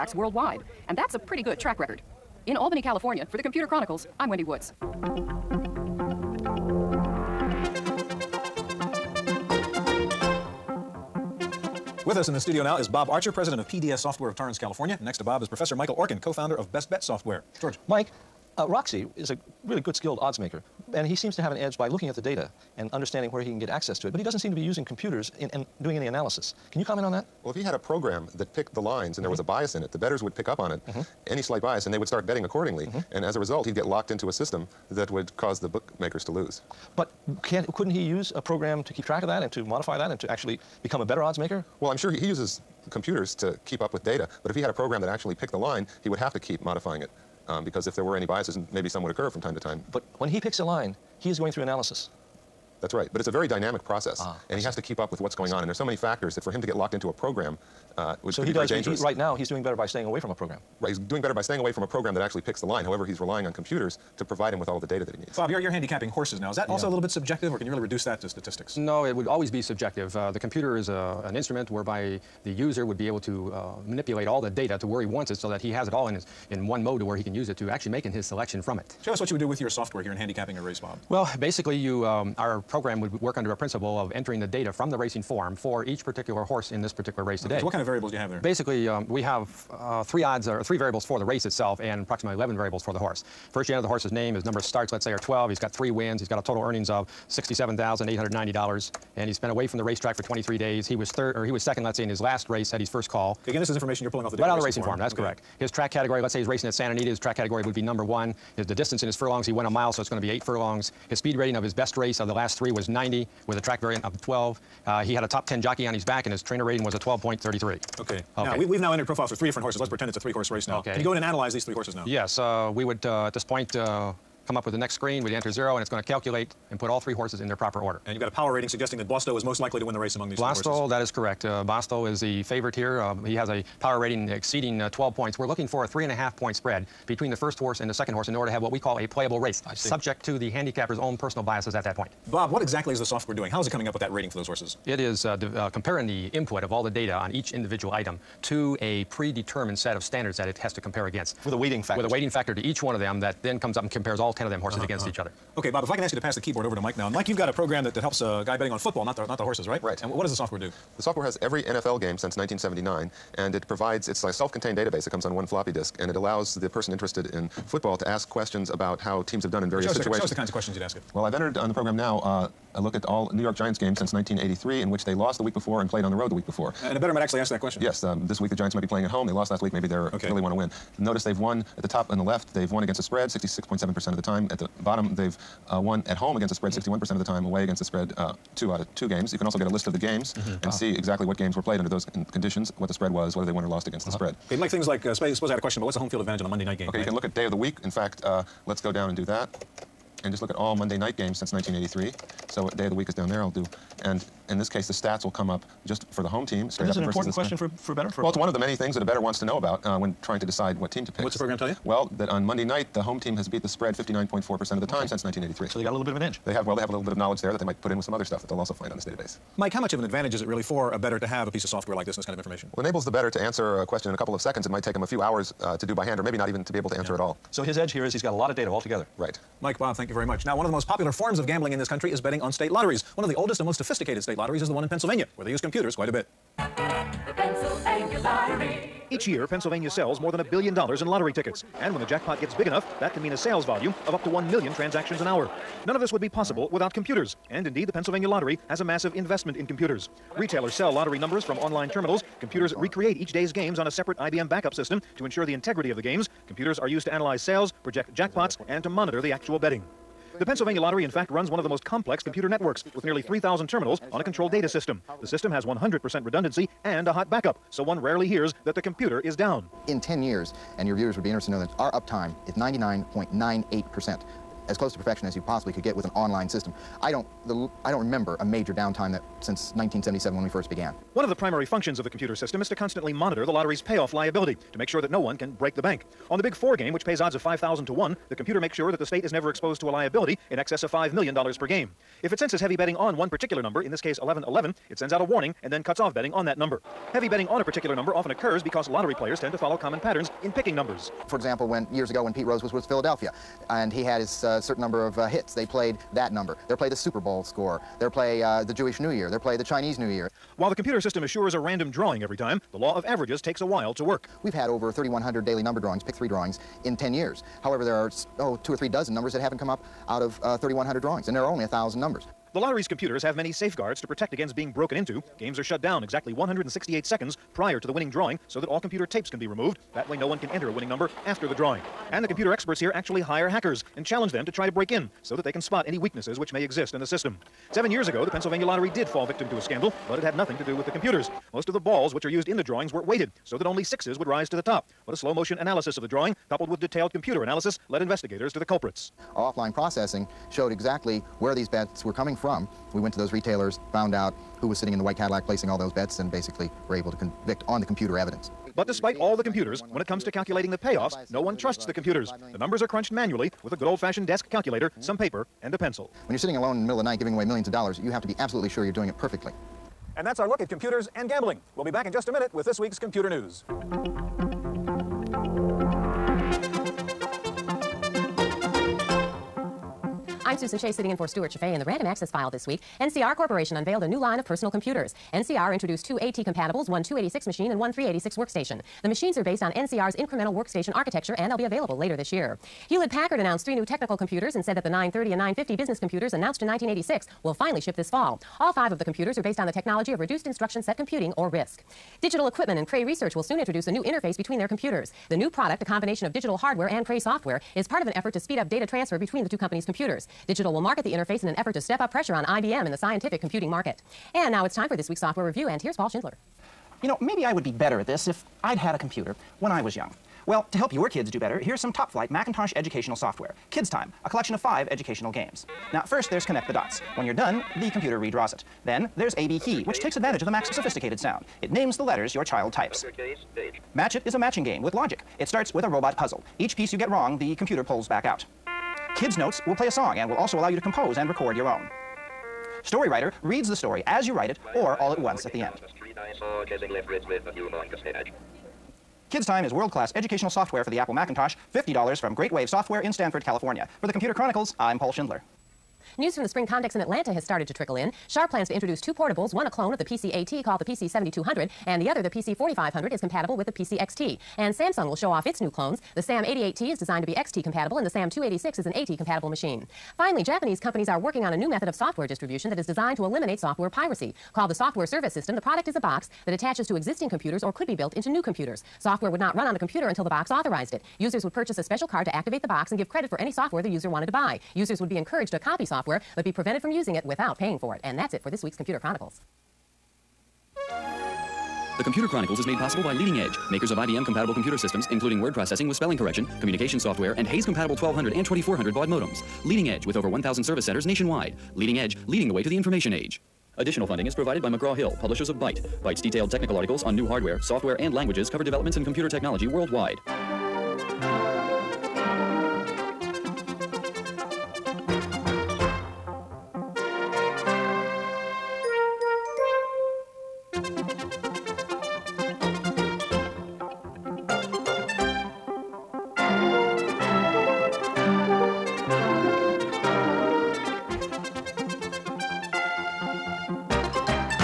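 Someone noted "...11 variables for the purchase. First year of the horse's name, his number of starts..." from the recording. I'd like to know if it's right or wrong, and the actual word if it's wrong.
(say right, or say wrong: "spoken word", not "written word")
wrong: "horse", not "purchase".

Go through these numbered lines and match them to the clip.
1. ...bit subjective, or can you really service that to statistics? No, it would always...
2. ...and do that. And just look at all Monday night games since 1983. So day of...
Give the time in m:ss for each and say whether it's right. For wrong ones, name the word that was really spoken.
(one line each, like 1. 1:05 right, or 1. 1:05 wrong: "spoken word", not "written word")
1. 1:06 wrong: "reduce", not "service"
2. 3:19 right.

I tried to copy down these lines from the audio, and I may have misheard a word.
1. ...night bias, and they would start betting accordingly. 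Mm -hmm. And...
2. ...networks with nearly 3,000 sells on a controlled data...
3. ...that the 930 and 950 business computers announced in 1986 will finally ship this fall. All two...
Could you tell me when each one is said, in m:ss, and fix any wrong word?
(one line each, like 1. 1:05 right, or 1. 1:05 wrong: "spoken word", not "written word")
1. 0:31 wrong: "slight", not "night"
2. 4:22 wrong: "terminals", not "sells"
3. 6:34 wrong: "five", not "two".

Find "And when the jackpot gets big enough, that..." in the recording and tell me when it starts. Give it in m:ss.
4:01.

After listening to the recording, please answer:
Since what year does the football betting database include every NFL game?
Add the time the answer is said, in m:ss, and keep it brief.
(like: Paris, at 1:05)
1979, at 2:42.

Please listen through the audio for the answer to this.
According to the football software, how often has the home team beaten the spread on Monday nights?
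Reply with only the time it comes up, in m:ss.
3:33.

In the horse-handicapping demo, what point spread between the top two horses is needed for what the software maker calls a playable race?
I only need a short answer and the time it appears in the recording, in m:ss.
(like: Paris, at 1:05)
three and a half point, at 2:15.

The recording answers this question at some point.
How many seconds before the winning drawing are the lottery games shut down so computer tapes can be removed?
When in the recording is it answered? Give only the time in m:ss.
5:26.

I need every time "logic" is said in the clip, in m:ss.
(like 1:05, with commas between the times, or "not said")
7:14.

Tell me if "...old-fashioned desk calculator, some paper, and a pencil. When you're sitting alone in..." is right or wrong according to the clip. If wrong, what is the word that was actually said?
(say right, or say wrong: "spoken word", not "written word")
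right.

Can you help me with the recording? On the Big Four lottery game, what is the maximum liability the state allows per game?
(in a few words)
$5 million.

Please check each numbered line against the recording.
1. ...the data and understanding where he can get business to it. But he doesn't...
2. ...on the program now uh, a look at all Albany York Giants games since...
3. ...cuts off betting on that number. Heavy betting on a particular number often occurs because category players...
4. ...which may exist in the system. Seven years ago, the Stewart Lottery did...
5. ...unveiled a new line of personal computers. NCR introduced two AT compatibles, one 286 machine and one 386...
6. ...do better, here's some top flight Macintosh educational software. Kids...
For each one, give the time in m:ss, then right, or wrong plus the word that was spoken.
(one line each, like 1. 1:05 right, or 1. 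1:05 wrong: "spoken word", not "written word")
1. 0:22 wrong: "access", not "business"
2. 2:51 wrong: "New", not "Albany"
3. 4:55 wrong: "lottery", not "category"
4. 5:36 wrong: "Pennsylvania", not "Stewart"
5. 6:23 right
6. 7:01 right.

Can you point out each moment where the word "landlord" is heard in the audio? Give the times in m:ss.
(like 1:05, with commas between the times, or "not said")
not said.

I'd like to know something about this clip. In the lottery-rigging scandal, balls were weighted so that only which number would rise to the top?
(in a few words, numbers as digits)
sixes.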